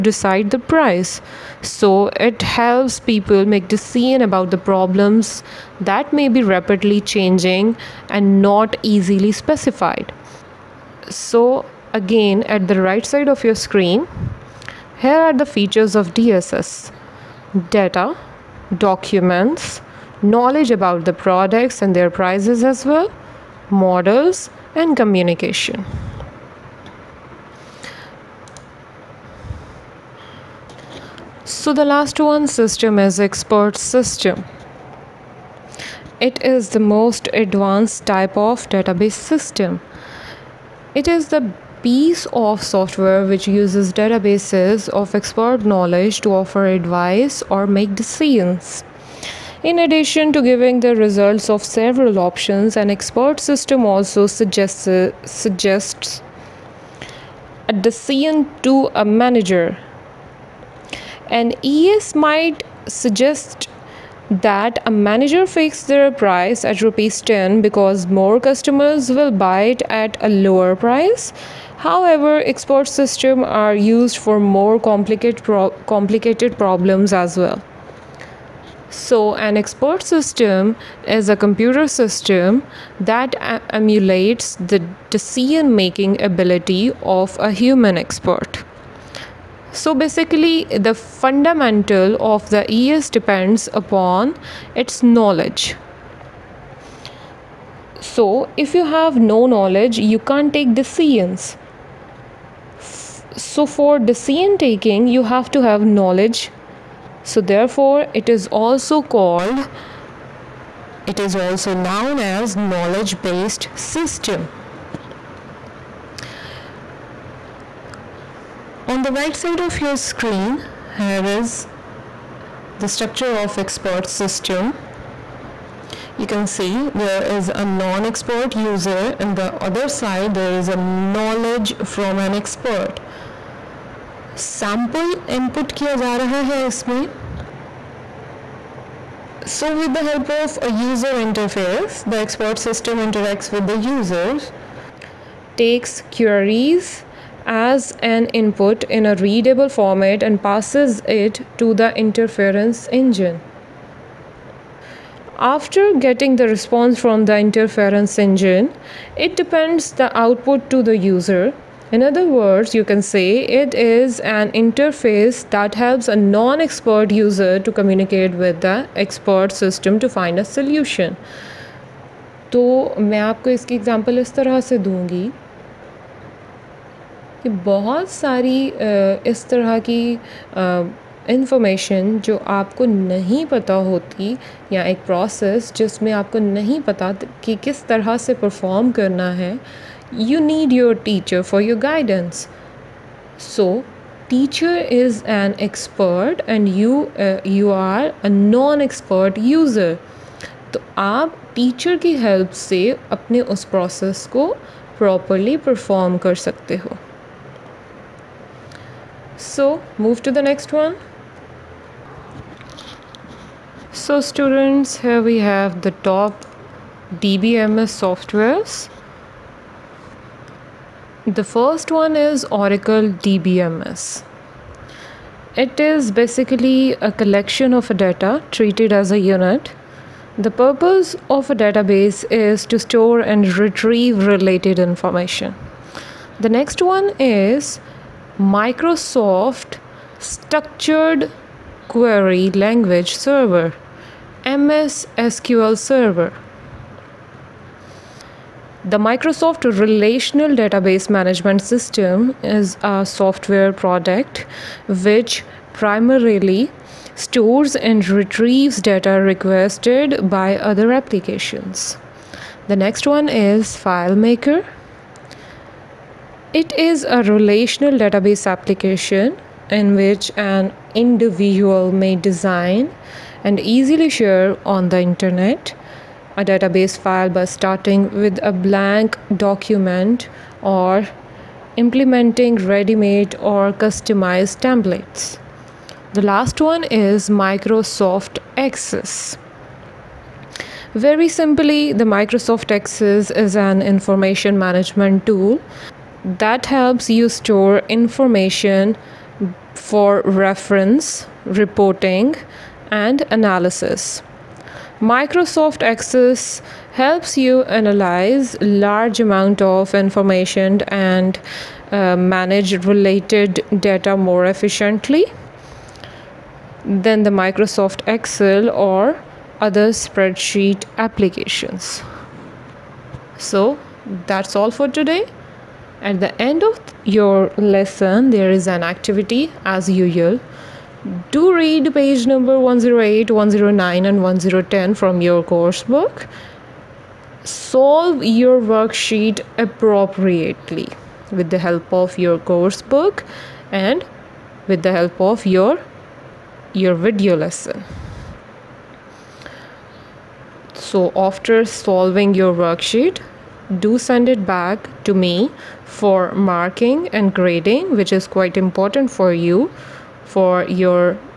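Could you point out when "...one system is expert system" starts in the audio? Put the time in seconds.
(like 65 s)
32 s.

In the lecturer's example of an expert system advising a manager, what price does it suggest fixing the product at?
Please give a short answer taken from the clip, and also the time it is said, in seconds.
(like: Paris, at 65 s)
10 rupees, at 66 s.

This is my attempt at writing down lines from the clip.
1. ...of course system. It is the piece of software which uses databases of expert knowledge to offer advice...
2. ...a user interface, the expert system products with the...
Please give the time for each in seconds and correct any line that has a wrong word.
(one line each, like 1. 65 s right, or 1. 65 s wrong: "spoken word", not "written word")
1. 38 s wrong: "database", not "course"
2. 140 s wrong: "interacts", not "products".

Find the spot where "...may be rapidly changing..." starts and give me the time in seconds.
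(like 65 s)
6 s.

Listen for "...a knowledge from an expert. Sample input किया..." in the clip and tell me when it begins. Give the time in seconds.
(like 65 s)
130 s.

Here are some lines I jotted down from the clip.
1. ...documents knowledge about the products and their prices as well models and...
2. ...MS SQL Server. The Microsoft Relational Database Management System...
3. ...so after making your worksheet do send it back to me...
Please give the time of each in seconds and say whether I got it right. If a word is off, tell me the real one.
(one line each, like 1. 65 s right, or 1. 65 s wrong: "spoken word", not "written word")
1. 18 s right
2. 244 s right
3. 350 s wrong: "solving", not "making".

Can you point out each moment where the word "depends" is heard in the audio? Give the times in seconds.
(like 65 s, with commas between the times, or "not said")
93 s, 159 s.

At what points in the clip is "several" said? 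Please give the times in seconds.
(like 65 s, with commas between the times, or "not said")
51 s.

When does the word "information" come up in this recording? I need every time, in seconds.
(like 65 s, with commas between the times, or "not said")
234 s, 293 s, 297 s, 309 s.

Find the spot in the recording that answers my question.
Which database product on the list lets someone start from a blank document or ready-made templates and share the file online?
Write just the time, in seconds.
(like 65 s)
263 s.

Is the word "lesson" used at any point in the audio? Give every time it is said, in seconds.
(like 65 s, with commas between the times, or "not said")
327 s, 347 s.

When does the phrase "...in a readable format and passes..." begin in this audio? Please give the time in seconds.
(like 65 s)
148 s.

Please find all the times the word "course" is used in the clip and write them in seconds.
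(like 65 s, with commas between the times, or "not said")
335 s, 342 s.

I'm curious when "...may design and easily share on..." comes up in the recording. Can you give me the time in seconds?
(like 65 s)
271 s.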